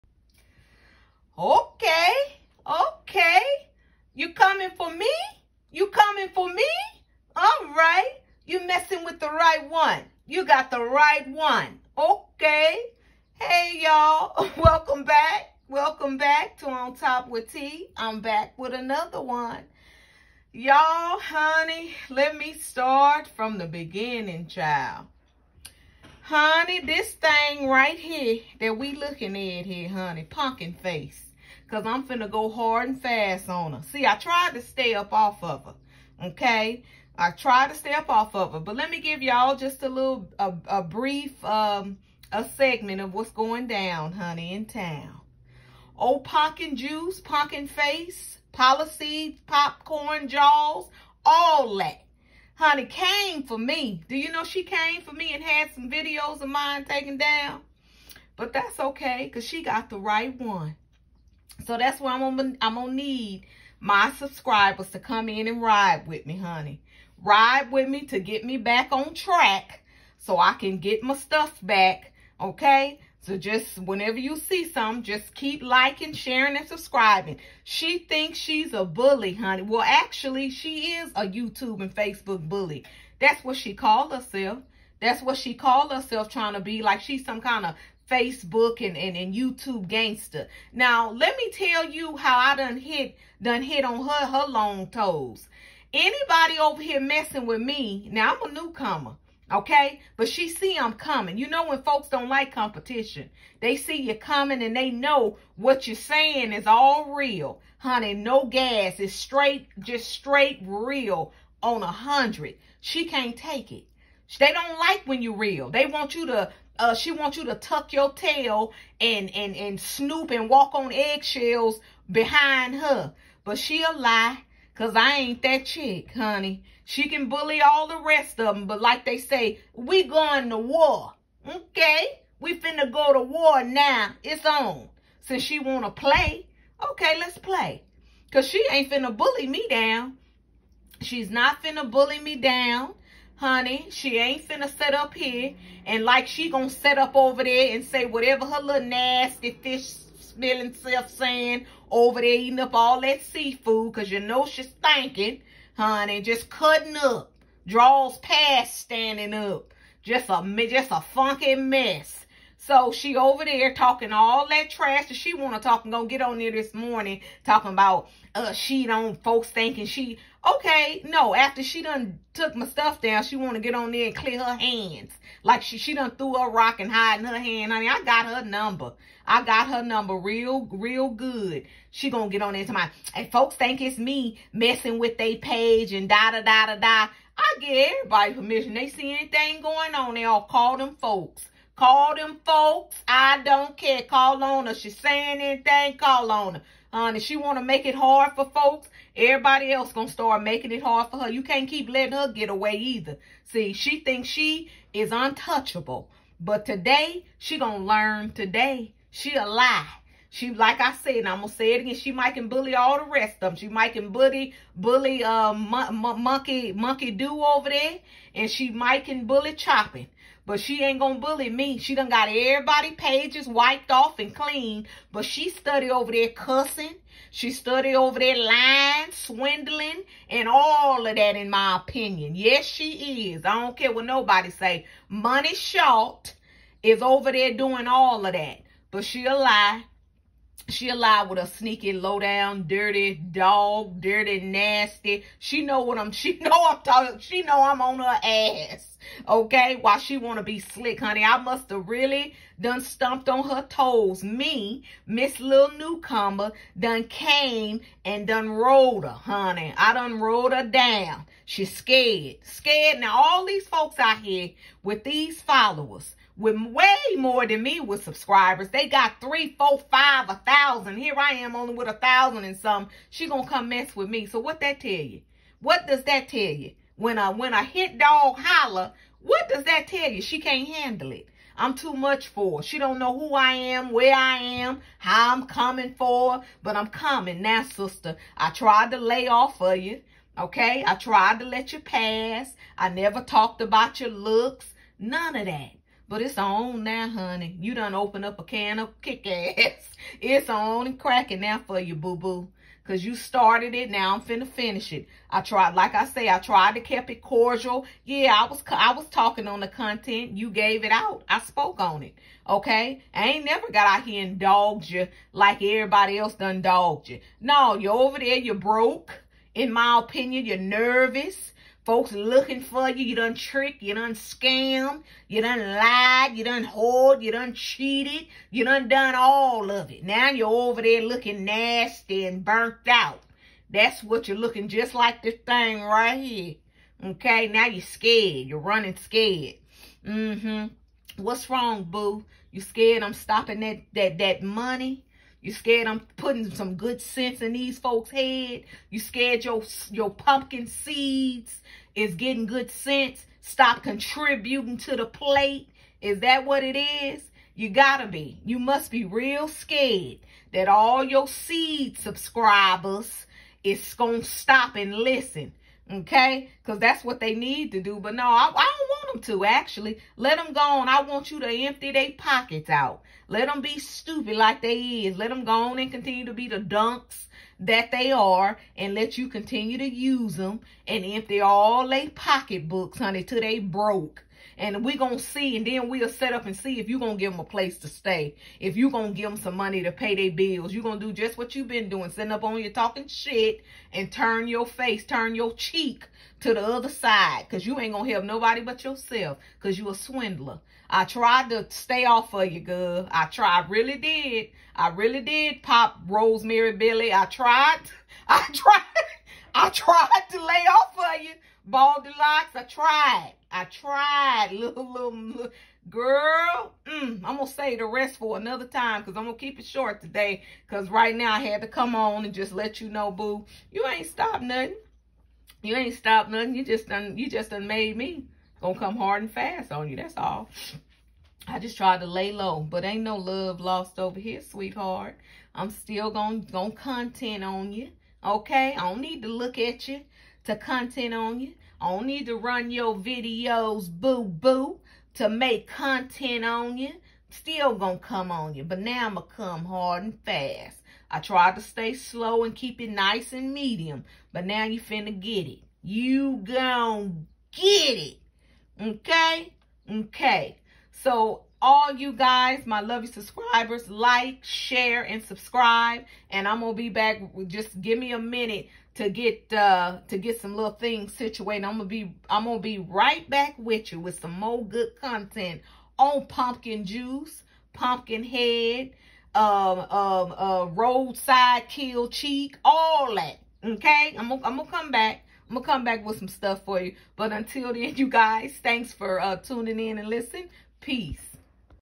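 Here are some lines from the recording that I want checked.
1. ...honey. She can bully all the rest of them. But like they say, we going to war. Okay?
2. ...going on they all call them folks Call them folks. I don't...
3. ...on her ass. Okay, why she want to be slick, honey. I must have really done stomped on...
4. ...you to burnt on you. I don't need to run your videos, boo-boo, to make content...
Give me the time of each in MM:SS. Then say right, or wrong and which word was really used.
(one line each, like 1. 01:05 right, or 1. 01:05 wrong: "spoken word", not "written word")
1. 02:06 right
2. 03:09 right
3. 04:07 right
4. 07:19 wrong: "content", not "burnt".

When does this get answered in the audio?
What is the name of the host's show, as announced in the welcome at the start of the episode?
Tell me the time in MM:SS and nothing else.
00:16.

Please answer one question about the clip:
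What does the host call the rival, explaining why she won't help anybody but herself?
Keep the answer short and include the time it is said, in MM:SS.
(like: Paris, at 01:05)
a swindler, at 06:39.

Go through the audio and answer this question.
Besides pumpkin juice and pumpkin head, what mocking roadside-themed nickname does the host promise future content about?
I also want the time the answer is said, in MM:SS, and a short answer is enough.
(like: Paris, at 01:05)
roadside kill cheek, at 08:00.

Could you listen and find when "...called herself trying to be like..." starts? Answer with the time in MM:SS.
01:25.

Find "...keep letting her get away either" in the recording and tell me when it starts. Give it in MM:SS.
03:21.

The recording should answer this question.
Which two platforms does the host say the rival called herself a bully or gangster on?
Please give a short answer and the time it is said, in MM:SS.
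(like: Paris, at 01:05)
YouTube and Facebook, at 01:21.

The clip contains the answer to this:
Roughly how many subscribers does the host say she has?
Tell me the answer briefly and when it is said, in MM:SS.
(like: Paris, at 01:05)
a thousand and some, at 04:31.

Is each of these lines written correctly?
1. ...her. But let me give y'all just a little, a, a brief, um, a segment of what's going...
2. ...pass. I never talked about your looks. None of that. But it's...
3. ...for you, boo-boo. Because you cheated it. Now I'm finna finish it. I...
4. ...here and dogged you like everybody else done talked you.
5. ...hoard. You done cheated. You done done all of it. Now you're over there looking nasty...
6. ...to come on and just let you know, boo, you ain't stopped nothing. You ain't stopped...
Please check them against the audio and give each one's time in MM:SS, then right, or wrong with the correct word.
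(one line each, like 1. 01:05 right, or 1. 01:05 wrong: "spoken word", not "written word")
1. 00:38 right
2. 04:51 right
3. 05:01 wrong: "started", not "cheated"
4. 05:14 wrong: "dogged", not "talked"
5. 05:26 right
6. 07:01 right.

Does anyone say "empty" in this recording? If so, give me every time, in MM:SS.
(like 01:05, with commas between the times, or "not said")
06:11, 06:21.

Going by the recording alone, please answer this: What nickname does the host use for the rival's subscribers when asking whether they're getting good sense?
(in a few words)
pumpkin seeds.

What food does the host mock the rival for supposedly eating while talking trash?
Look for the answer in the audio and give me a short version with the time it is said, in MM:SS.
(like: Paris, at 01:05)
seafood, at 02:33.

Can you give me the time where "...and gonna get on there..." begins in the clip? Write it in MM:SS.
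02:45.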